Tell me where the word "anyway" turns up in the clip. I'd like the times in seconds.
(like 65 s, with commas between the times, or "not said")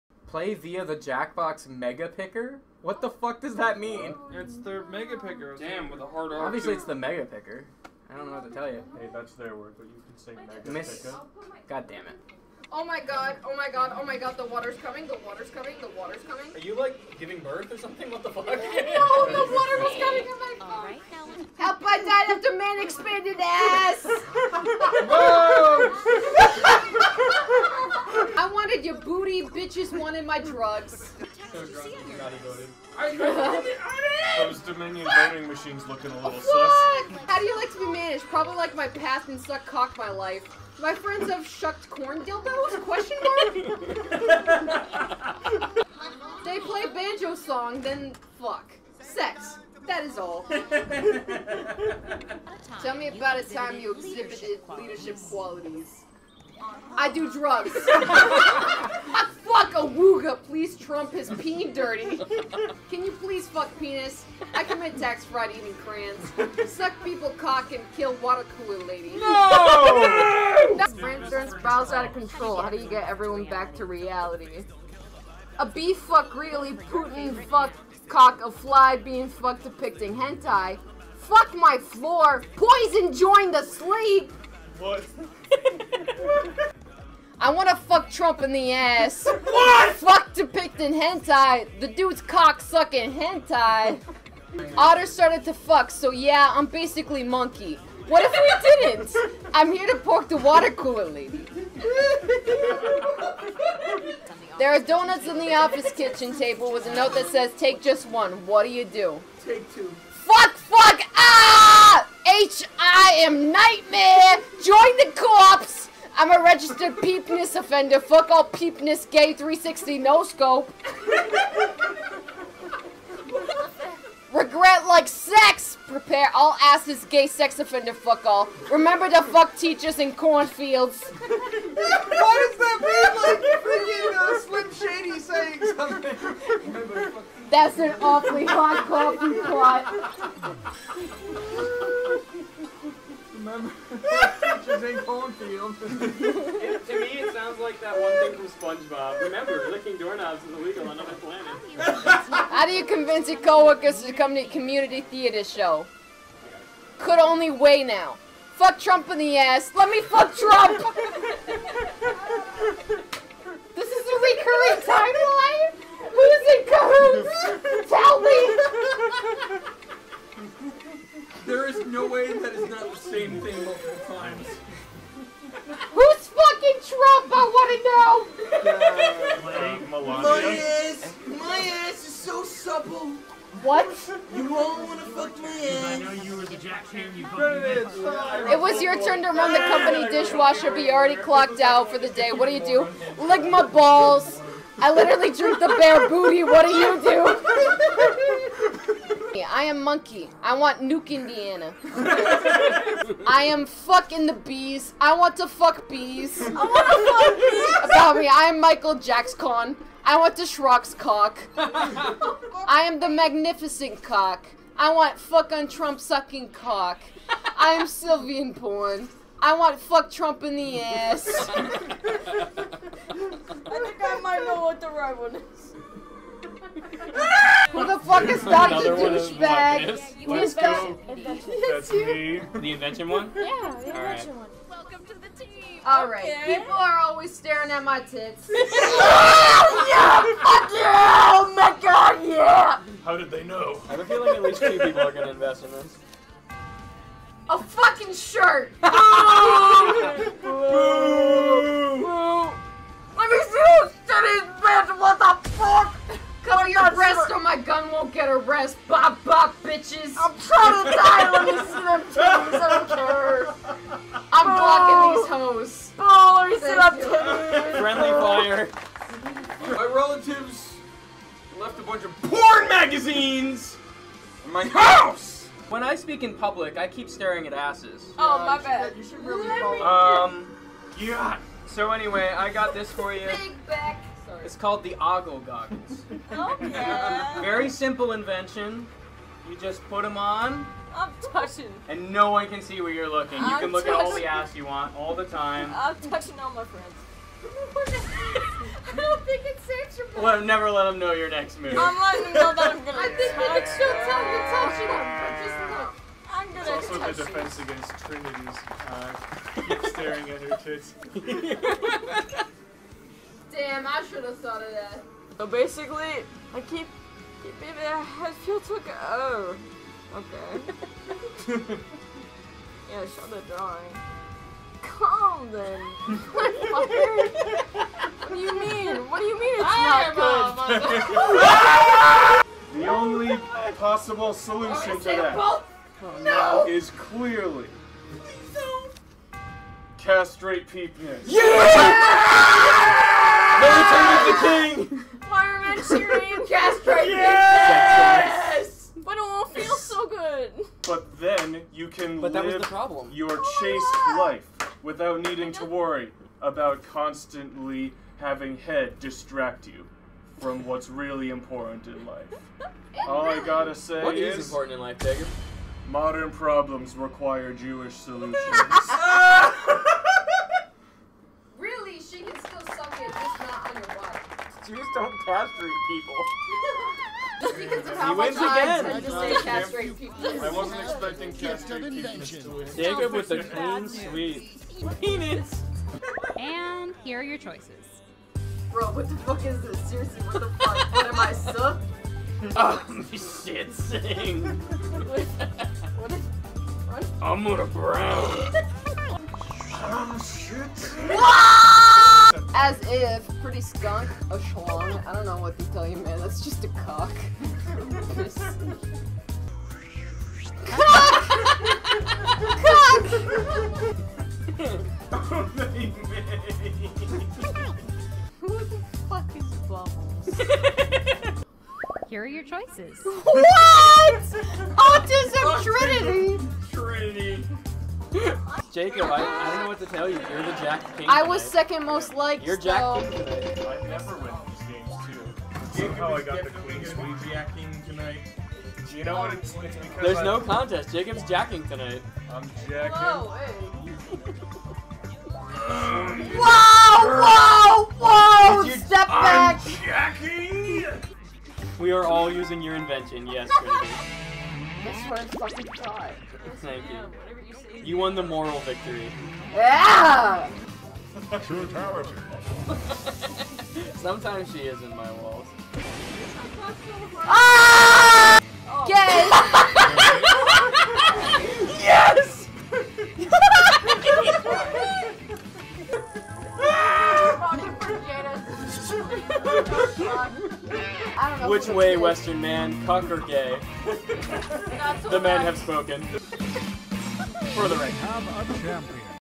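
281 s.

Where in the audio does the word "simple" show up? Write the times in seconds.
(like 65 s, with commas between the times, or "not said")
287 s.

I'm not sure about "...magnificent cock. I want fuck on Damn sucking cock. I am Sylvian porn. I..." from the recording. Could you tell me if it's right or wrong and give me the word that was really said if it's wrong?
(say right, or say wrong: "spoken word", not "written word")
wrong: "Trump", not "Damn".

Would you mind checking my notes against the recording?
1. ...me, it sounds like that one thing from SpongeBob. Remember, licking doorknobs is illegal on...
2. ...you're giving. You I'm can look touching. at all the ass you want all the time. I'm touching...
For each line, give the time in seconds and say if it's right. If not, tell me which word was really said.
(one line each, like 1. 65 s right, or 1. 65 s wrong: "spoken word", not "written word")
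1. 146 s right
2. 292 s wrong: "looking", not "giving".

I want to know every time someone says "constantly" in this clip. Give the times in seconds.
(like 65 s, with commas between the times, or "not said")
356 s.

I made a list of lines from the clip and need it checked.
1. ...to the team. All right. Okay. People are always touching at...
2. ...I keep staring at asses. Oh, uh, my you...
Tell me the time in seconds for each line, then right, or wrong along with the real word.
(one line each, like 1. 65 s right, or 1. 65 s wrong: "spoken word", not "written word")
1. 235 s wrong: "staring", not "touching"
2. 276 s right.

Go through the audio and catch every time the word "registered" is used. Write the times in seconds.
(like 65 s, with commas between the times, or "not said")
116 s.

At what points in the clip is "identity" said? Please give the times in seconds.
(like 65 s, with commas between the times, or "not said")
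not said.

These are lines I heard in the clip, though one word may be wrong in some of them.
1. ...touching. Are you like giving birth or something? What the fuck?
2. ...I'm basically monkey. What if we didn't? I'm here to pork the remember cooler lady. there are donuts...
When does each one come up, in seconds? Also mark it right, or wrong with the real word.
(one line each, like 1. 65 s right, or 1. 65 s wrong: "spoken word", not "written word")
1. 16 s wrong: "coming", not "touching"
2. 96 s wrong: "water", not "remember".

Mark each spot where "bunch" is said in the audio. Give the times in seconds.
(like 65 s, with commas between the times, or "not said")
271 s.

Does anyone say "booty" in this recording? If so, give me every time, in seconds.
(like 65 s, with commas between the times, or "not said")
28 s, 196 s.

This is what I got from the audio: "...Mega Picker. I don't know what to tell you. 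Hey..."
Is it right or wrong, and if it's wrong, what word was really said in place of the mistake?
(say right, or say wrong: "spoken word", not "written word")
right.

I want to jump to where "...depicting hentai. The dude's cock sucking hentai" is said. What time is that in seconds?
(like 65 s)
90 s.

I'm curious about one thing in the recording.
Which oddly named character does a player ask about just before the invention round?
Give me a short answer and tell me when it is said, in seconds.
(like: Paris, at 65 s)
Dr. Douchebag, at 228 s.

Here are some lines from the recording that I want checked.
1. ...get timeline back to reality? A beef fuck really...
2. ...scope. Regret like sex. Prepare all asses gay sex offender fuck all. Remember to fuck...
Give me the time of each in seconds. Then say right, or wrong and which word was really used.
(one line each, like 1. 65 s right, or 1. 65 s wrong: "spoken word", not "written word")
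1. 72 s wrong: "everyone", not "timeline"
2. 120 s right.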